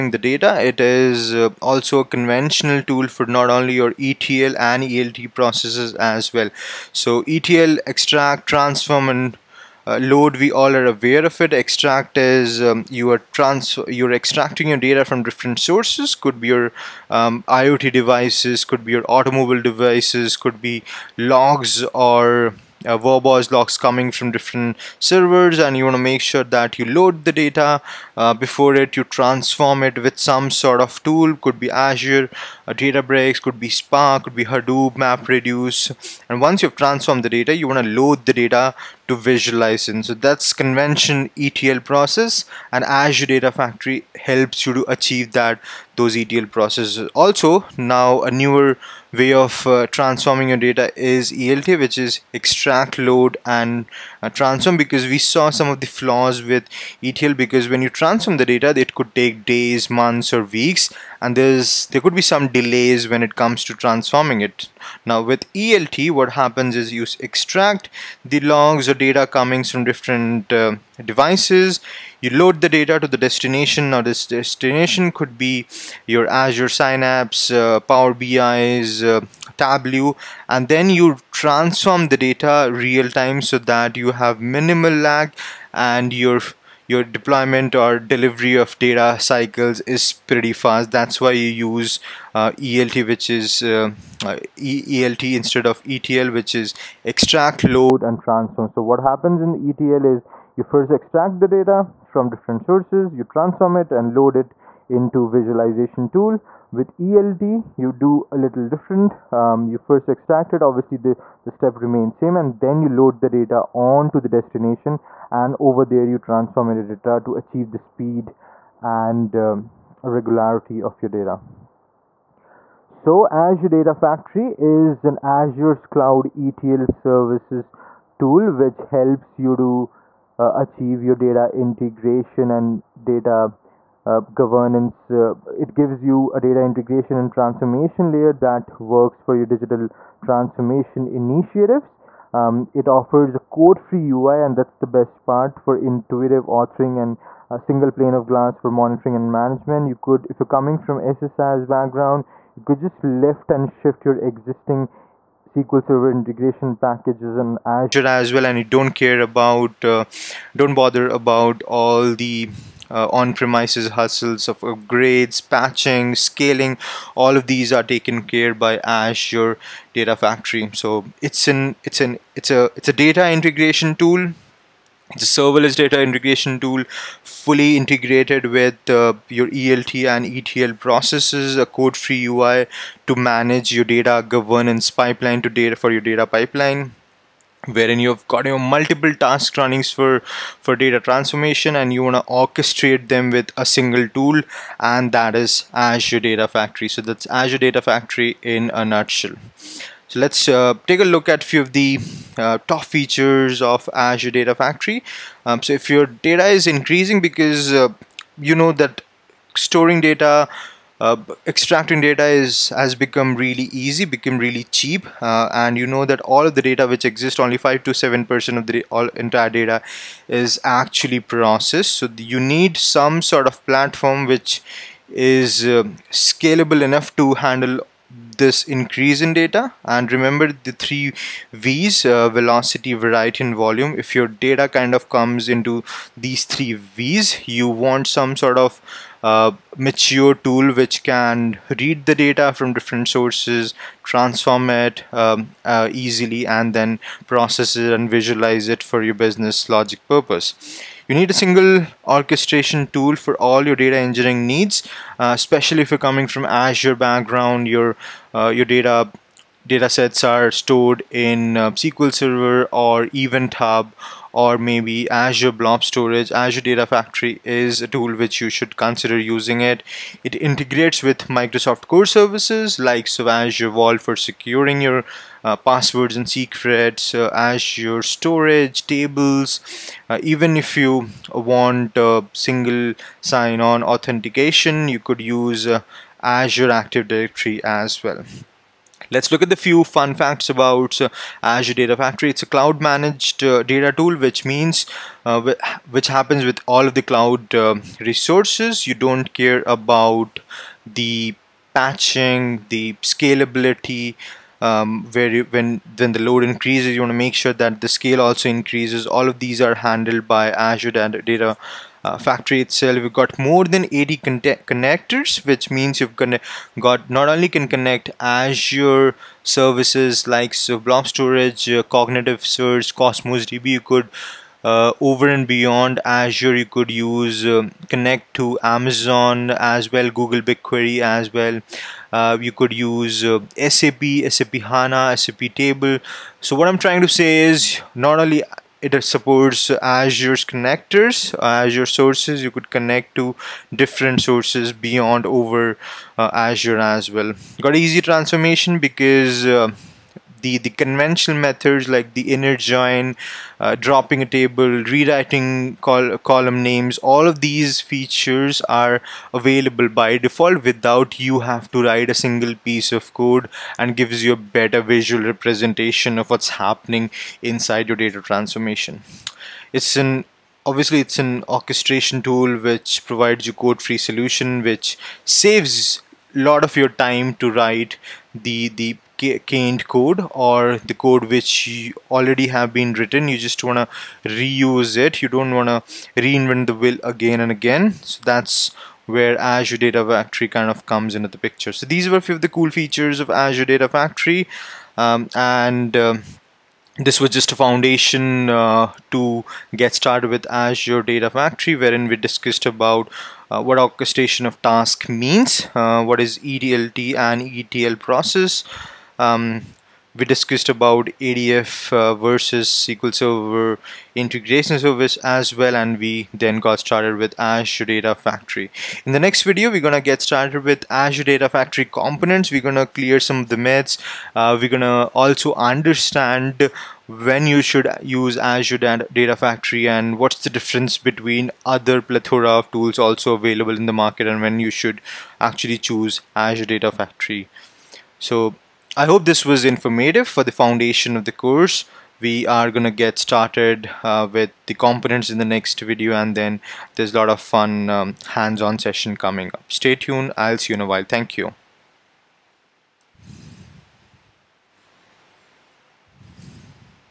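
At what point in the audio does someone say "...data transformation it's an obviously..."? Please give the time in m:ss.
6:07.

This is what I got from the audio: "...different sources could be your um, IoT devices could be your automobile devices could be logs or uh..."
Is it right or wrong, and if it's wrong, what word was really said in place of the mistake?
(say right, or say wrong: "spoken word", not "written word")
right.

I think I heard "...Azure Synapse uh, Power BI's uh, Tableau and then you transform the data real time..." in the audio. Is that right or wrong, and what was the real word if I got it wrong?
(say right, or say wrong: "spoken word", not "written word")
right.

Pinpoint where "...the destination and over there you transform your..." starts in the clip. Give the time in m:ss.
1:54.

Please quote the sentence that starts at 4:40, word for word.
Uh, even if you want single sign-on authentication, you could use uh, Azure Active Directory as well.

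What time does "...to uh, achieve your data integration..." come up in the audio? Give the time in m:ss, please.
2:09.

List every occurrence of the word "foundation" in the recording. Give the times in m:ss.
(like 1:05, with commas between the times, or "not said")
6:37, 7:20.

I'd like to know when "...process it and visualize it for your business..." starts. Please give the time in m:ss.
4:07.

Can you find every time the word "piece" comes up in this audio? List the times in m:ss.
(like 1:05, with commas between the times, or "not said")
6:02.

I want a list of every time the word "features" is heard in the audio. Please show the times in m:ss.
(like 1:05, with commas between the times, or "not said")
3:22, 5:57, 6:32.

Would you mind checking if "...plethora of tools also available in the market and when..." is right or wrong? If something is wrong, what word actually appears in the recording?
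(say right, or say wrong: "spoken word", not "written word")
right.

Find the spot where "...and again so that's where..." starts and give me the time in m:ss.
6:27.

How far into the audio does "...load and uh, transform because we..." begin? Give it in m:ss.
0:52.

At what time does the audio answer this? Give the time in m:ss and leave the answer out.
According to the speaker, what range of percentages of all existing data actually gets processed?
3:37.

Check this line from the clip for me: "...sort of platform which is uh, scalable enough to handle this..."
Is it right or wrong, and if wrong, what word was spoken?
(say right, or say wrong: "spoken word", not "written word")
right.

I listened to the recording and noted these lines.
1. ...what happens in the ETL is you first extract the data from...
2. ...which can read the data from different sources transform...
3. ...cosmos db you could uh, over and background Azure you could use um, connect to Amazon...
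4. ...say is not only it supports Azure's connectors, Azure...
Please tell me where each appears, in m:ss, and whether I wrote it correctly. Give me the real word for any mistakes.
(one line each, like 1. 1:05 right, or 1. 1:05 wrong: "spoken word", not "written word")
1. 1:38 right
2. 4:00 right
3. 5:23 wrong: "beyond", not "background"
4. 5:37 right.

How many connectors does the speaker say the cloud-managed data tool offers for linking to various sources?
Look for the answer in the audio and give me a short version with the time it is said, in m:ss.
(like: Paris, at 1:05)
more than 80, at 5:13.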